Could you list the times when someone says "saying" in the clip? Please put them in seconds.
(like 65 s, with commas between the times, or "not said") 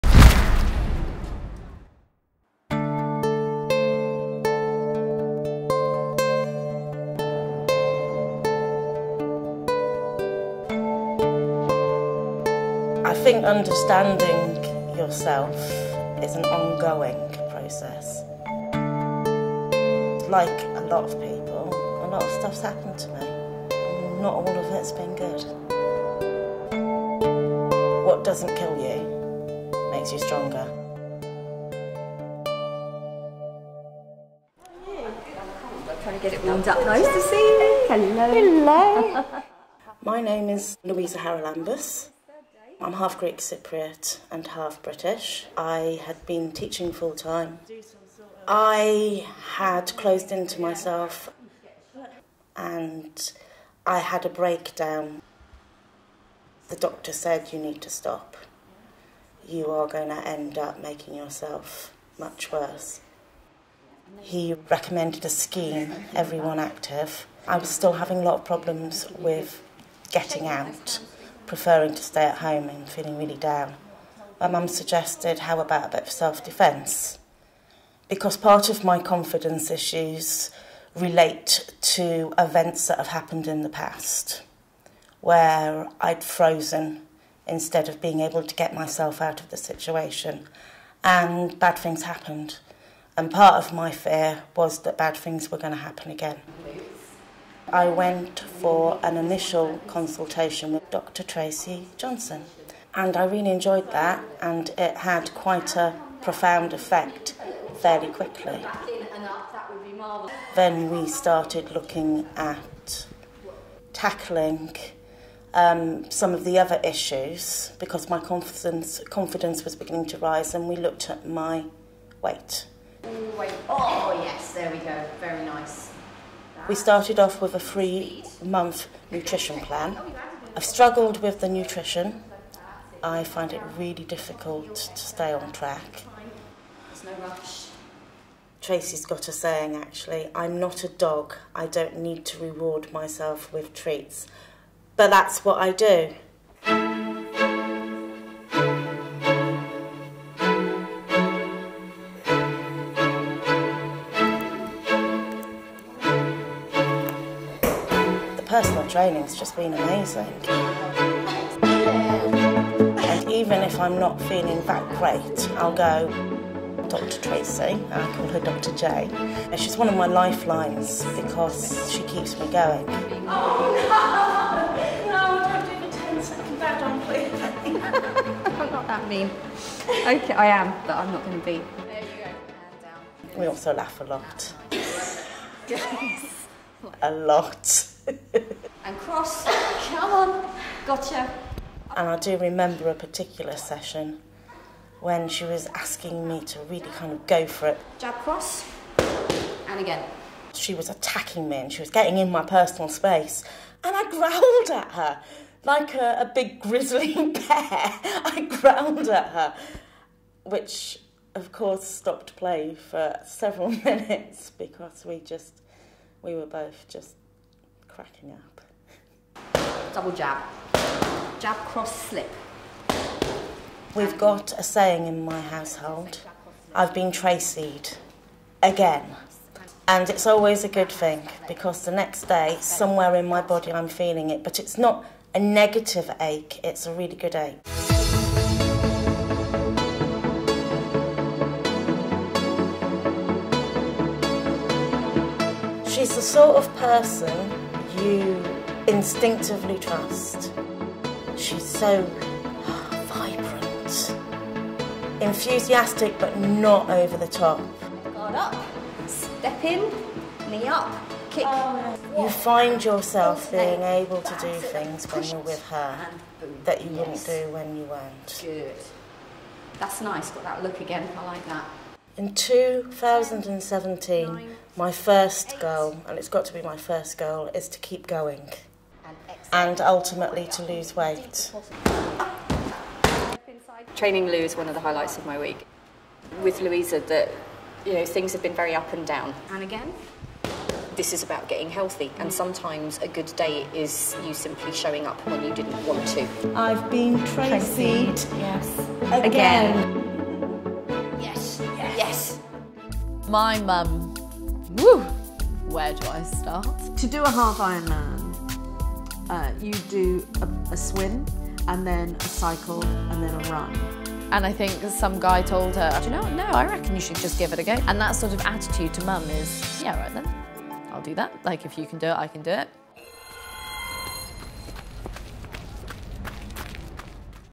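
139 s, 224 s.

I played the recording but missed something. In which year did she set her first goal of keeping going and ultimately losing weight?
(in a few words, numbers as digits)
2017.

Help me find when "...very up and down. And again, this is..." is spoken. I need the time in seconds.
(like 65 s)
288 s.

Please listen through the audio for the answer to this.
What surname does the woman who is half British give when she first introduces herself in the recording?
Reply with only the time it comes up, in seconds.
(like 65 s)
41 s.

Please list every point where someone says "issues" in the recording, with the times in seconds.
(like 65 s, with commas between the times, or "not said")
79 s, 116 s.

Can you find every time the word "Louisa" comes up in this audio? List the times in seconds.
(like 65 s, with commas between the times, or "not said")
40 s, 286 s.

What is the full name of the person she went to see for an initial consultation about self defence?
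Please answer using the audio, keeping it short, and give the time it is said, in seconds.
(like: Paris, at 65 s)
Dr. Tracy Johnson, at 100 s.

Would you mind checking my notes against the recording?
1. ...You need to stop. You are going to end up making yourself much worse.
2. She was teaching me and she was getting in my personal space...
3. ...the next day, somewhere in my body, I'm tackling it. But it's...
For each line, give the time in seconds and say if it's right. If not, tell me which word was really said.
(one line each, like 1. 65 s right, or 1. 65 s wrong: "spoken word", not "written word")
1. 57 s right
2. 200 s wrong: "attacking", not "teaching"
3. 231 s wrong: "feeling", not "tackling".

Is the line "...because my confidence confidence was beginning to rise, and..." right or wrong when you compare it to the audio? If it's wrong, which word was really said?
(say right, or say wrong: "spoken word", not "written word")
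right.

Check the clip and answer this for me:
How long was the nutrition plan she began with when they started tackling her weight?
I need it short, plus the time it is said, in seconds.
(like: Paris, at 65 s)
3 months, at 127 s.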